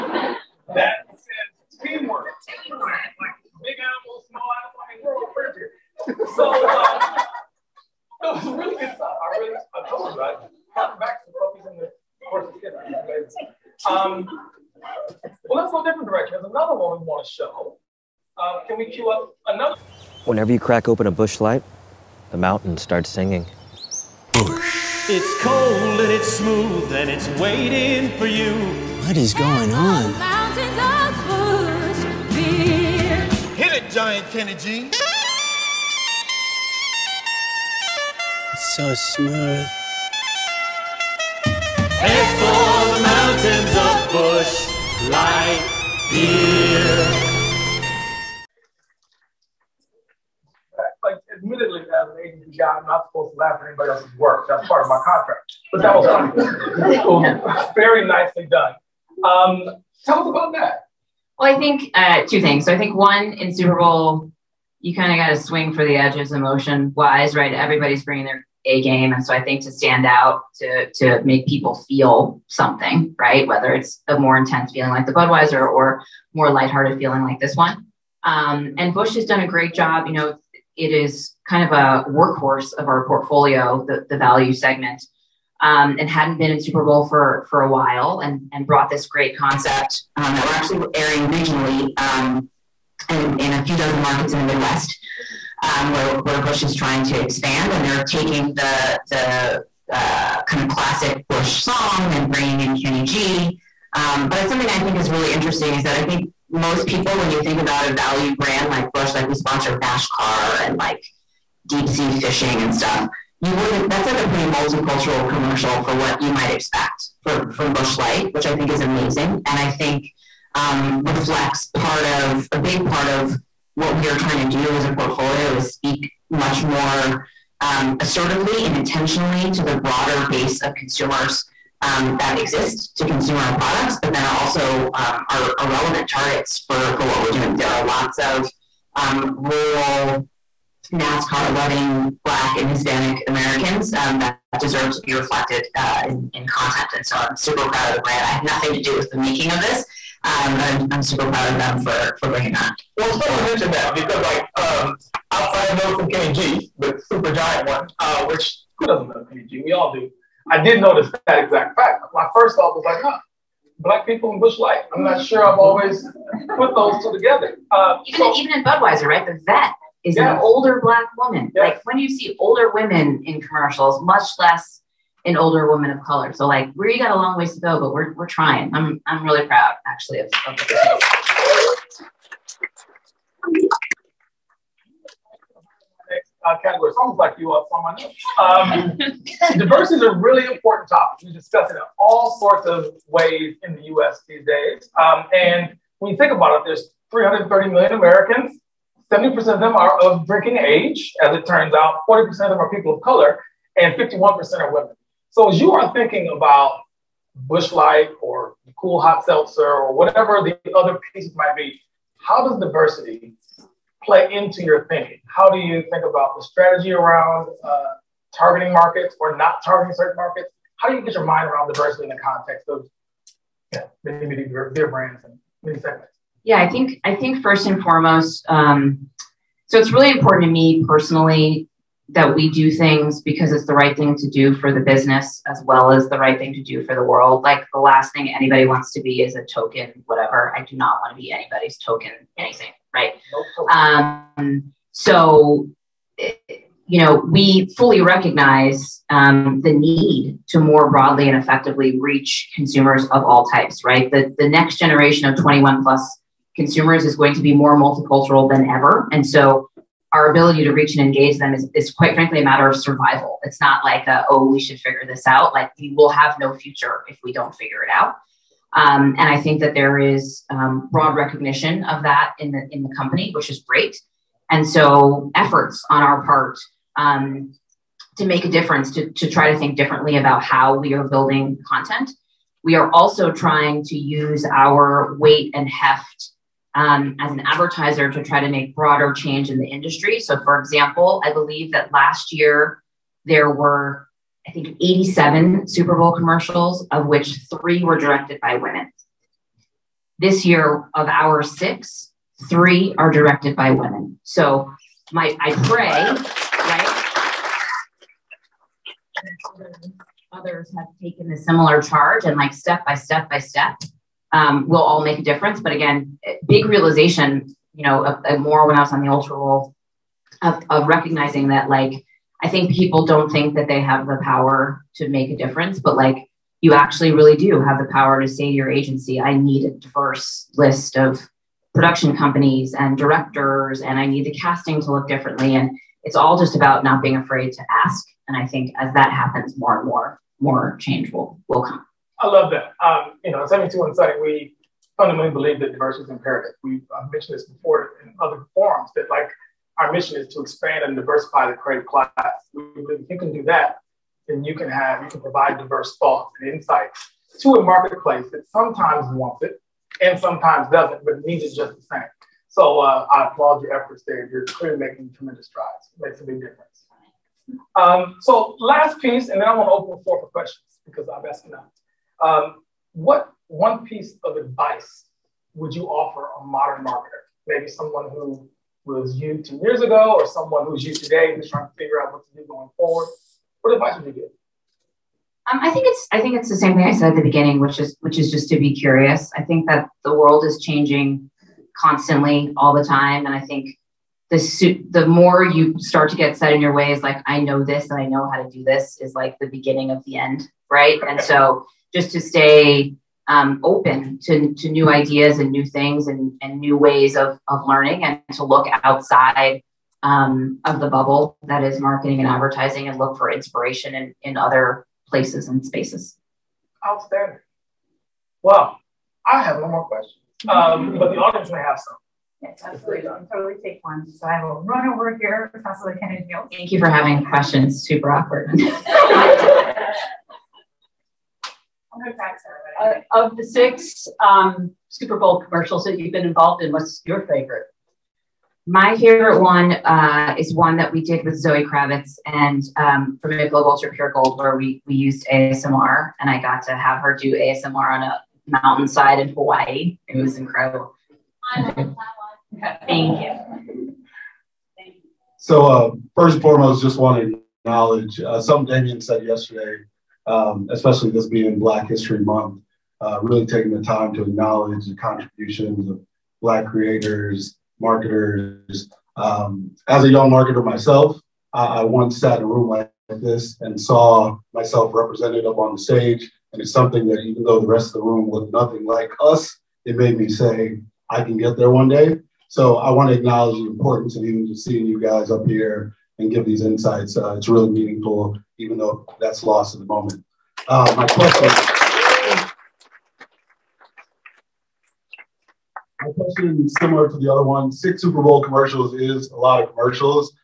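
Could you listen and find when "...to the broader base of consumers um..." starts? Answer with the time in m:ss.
2:09.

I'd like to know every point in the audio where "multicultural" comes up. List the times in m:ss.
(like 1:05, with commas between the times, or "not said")
1:54, 4:17.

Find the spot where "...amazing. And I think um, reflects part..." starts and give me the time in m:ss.
1:58.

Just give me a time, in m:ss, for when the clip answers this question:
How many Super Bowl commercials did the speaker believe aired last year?
4:54.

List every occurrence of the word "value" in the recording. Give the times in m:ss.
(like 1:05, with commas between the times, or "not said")
1:24, 1:47.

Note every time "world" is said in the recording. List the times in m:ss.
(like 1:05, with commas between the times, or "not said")
3:57, 6:30.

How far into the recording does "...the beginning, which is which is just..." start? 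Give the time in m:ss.
6:27.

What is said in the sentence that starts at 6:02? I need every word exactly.
So uh, I applaud your efforts there.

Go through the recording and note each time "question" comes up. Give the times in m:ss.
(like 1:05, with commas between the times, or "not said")
6:10, 6:59, 7:07, 8:11, 8:16.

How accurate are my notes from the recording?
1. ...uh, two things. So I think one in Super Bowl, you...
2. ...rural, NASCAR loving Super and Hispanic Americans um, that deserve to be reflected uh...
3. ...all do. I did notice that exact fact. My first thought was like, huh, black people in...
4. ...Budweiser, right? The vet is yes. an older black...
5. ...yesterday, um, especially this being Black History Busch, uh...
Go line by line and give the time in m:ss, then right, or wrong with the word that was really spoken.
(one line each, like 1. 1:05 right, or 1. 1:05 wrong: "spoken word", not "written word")
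1. 1:01 right
2. 2:19 wrong: "Black", not "Super"
3. 2:39 right
4. 2:48 right
5. 7:39 wrong: "Month", not "Busch".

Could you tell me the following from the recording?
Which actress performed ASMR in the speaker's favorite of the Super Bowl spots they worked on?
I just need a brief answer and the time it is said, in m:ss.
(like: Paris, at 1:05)
Zoe Kravitz, at 7:21.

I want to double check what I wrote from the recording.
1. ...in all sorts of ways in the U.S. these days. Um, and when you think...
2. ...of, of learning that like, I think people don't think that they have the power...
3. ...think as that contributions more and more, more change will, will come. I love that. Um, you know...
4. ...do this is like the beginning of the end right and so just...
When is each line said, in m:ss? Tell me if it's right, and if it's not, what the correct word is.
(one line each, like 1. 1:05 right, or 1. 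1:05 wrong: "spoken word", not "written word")
1. 3:11 right
2. 5:20 wrong: "recognizing", not "learning"
3. 5:38 wrong: "happens", not "contributions"
4. 6:38 right.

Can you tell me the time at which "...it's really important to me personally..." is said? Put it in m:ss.
3:49.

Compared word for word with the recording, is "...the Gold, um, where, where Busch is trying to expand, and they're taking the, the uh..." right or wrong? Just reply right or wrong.
wrong.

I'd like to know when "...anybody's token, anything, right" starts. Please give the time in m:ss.
4:01.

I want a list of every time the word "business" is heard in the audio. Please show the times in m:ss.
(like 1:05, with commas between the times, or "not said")
3:54.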